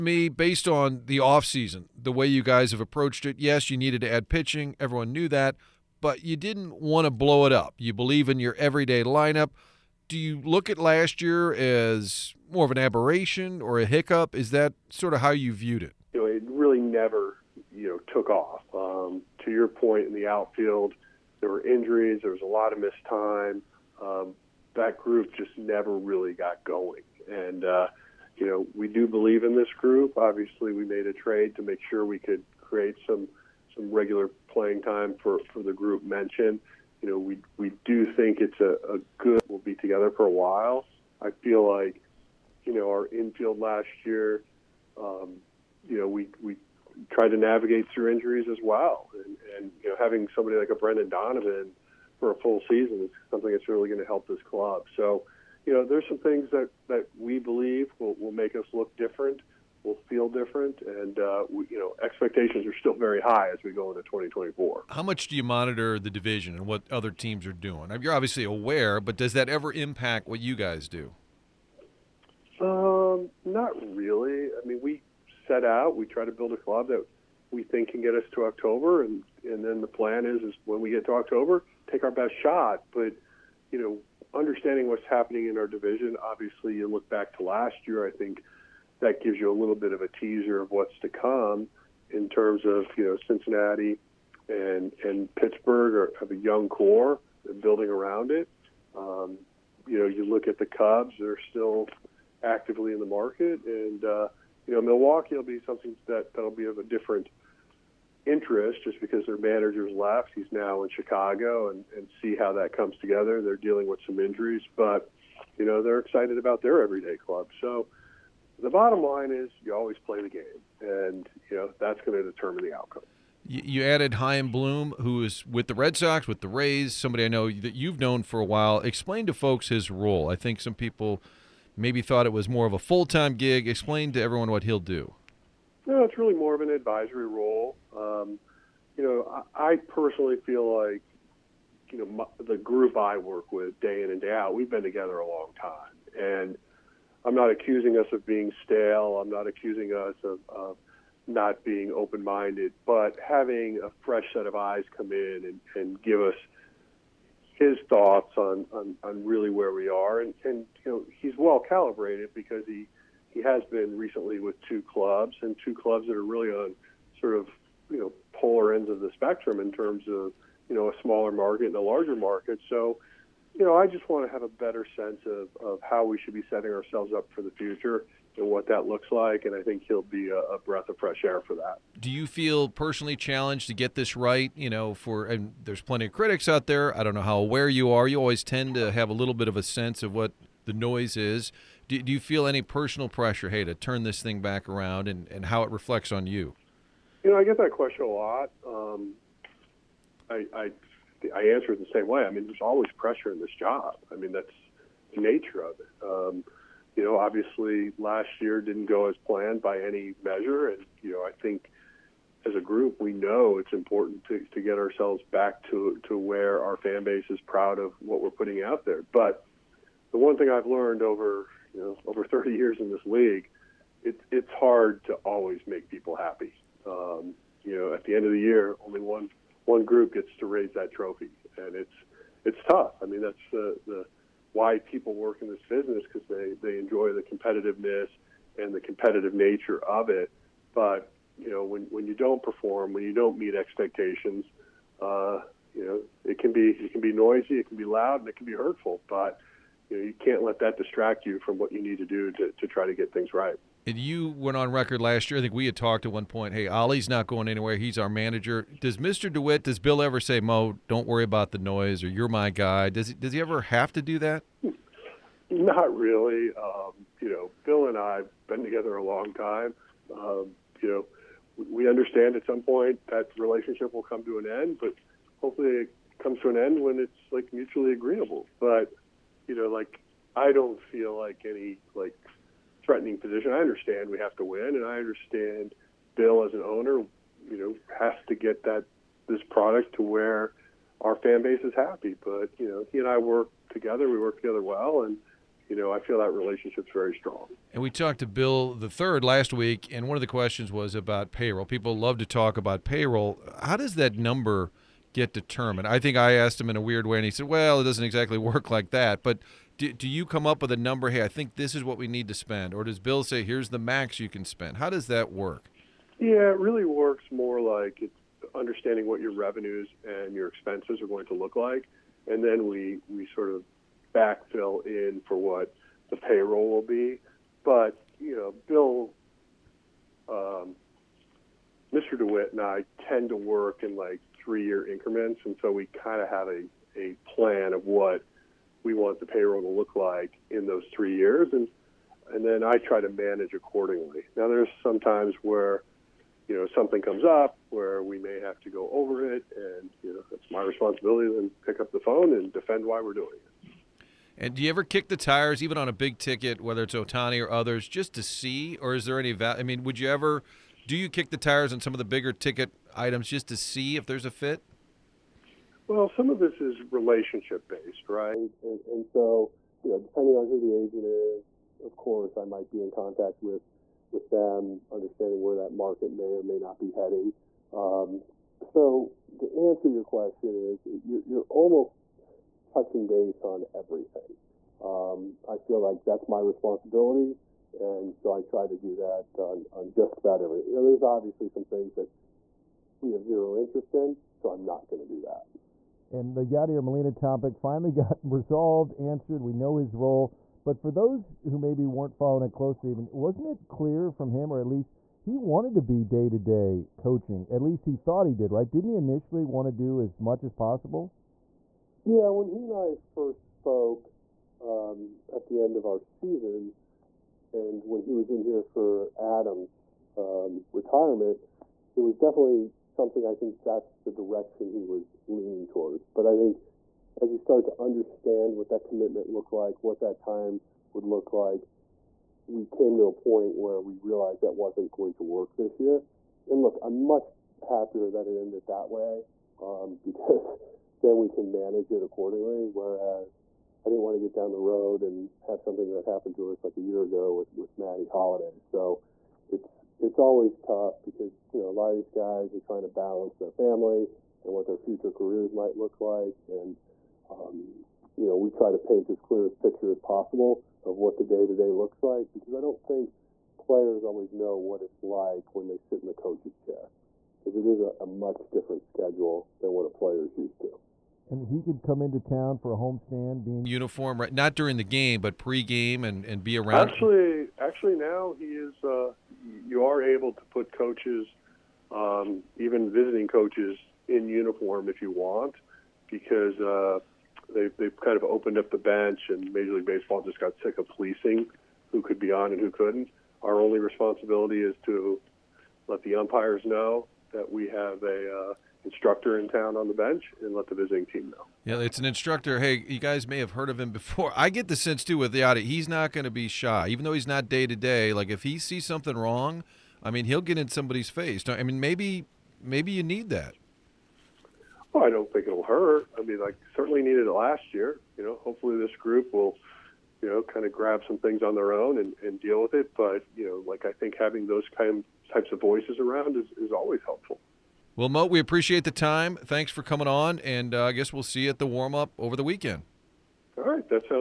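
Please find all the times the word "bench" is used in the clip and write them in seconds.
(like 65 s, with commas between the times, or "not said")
488 s, 499 s.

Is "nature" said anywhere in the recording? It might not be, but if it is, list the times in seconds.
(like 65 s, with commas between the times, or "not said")
205 s, 239 s.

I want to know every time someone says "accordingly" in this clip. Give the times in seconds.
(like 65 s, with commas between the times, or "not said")
343 s, 442 s.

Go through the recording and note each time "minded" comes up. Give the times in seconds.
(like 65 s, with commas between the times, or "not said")
151 s.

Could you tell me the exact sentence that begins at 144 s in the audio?
We've been together a long time, and I'm not accusing us of being stale.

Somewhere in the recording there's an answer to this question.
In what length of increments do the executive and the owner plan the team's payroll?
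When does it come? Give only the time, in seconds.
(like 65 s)
334 s.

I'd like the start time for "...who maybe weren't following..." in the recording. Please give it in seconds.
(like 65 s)
401 s.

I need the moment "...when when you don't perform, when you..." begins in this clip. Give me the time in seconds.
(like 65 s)
241 s.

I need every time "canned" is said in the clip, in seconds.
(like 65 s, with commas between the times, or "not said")
not said.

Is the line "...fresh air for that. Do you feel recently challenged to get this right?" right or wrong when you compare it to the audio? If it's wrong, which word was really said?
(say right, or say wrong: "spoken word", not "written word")
wrong: "personally", not "recently".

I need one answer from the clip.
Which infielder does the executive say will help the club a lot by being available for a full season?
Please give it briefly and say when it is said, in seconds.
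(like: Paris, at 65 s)
Brendan Donovan, at 50 s.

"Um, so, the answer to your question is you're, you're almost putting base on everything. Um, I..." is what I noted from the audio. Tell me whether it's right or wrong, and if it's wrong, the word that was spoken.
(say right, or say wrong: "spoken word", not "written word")
wrong: "touching", not "putting".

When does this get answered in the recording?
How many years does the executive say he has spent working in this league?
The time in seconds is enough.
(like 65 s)
222 s.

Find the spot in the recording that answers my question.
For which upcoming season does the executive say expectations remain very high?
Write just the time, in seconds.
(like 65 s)
64 s.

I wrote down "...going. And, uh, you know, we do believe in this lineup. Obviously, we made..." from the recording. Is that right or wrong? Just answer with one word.
wrong.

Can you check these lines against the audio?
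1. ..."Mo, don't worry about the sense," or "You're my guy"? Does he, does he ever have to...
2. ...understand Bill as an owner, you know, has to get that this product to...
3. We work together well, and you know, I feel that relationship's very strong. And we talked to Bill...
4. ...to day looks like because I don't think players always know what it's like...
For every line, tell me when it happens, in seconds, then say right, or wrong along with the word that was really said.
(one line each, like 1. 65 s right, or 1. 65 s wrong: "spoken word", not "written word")
1. 260 s wrong: "noise", not "sense"
2. 284 s right
3. 294 s right
4. 461 s right.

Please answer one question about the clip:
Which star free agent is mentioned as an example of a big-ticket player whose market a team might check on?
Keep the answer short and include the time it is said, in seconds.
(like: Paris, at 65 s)
Ohtani, at 356 s.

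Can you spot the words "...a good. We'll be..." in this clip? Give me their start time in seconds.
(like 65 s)
38 s.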